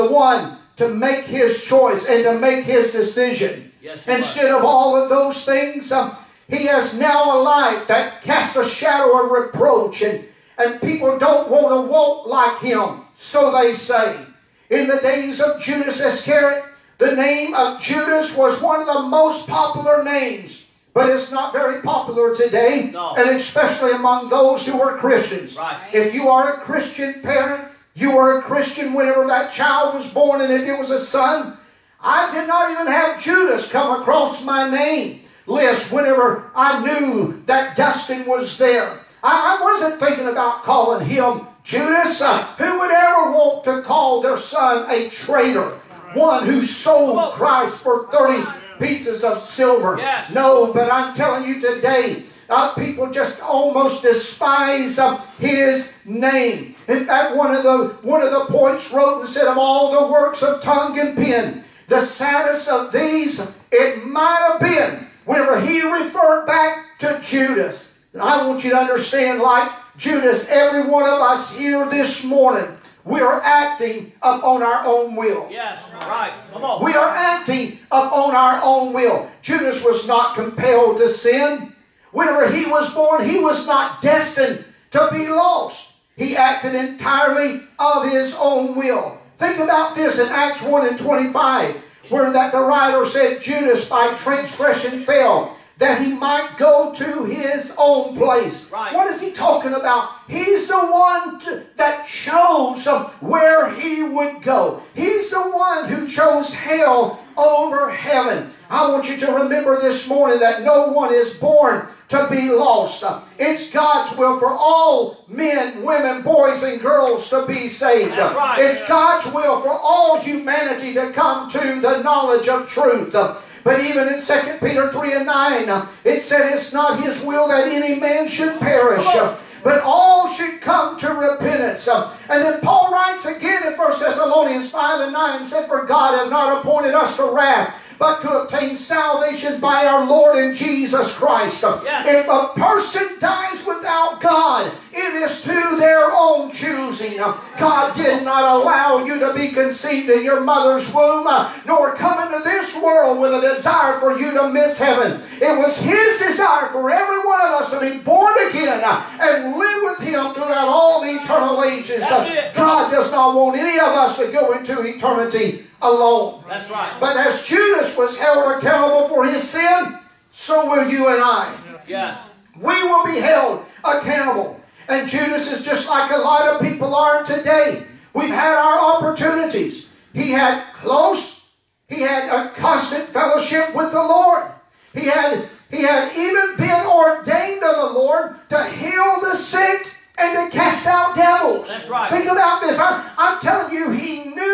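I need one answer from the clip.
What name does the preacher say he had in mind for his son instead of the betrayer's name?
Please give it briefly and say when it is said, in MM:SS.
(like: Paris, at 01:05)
Dustin, at 00:37.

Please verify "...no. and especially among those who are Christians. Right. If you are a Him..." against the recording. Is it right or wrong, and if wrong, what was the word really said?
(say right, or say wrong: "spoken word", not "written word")
wrong: "Christian", not "Him".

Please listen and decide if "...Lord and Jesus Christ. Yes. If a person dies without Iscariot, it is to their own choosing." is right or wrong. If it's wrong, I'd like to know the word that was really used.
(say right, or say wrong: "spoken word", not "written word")
wrong: "God", not "Iscariot".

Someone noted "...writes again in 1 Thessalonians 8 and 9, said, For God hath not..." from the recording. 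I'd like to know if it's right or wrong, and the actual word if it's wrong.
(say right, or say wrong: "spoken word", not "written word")
wrong: "5", not "8".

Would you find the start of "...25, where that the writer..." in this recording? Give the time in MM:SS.
01:30.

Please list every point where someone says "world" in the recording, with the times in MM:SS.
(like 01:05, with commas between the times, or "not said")
02:32.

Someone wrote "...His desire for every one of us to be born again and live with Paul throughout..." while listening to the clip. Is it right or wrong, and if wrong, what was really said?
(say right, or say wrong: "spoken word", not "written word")
wrong: "Him", not "Paul".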